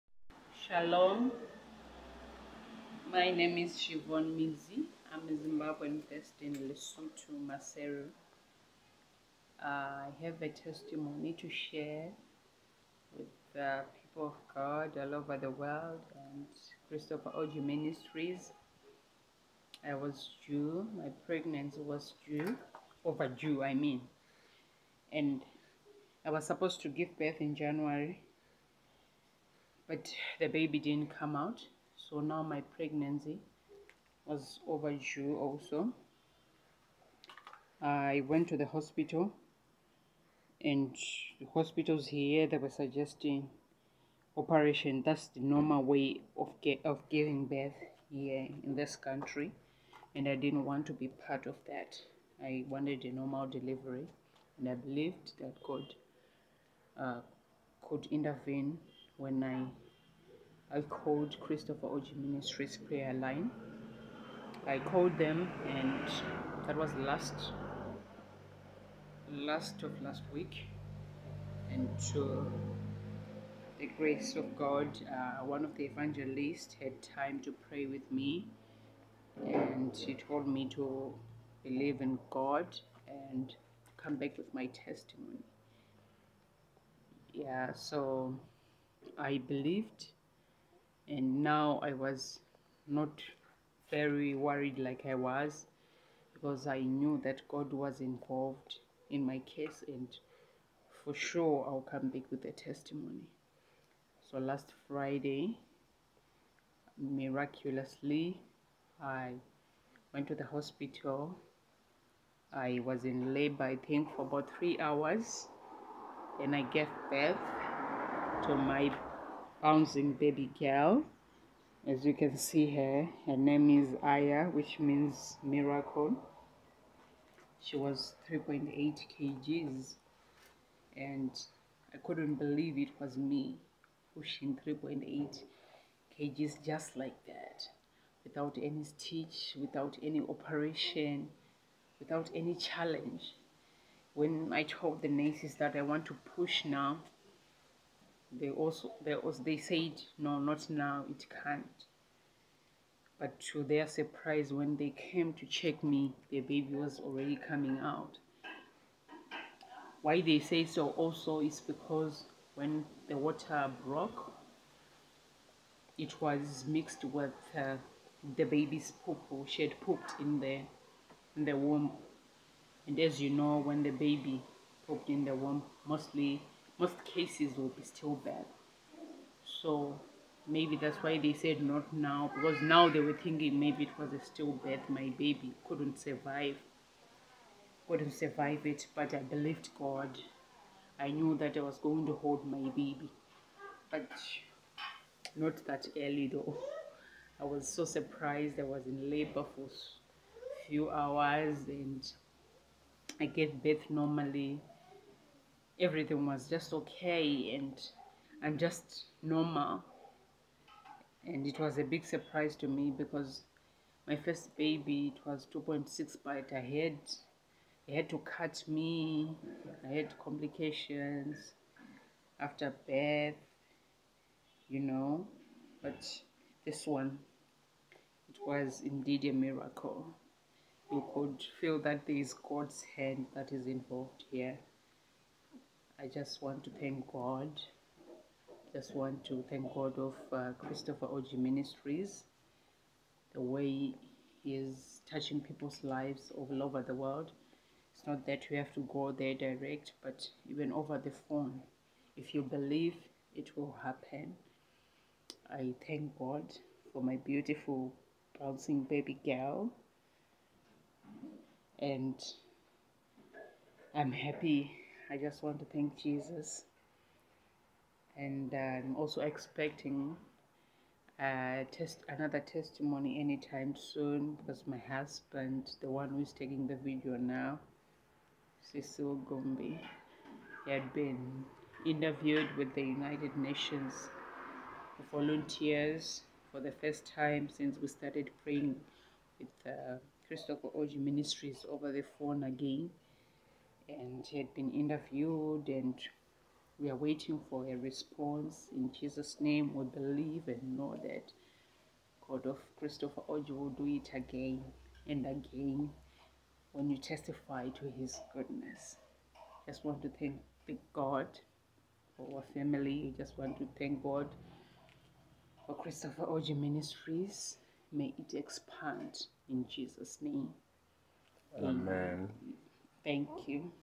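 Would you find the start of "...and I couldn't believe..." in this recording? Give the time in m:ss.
2:10.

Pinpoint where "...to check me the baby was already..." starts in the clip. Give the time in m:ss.
2:35.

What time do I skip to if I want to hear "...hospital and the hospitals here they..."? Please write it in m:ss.
0:38.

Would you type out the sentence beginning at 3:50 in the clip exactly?
You could feel that there is God's hand that is involved here.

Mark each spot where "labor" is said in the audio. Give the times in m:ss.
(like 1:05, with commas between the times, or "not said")
1:53, 3:19.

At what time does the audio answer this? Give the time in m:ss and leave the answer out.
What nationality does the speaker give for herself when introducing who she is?
0:05.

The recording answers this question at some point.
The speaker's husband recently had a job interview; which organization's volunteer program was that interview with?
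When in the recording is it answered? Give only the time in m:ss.
4:42.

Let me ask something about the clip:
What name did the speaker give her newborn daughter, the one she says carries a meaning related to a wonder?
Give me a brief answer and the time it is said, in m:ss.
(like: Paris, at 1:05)
Aya, at 2:04.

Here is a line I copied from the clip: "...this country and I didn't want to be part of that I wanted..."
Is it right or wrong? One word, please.
right.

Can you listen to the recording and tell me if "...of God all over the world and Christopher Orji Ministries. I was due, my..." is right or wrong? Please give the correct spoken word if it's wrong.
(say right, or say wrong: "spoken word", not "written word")
right.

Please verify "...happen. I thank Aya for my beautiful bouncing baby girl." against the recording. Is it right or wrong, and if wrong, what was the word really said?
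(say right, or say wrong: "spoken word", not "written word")
wrong: "God", not "Aya".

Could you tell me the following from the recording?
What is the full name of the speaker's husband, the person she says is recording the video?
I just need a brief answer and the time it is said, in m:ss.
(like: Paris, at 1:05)
Cecil Gombe, at 4:38.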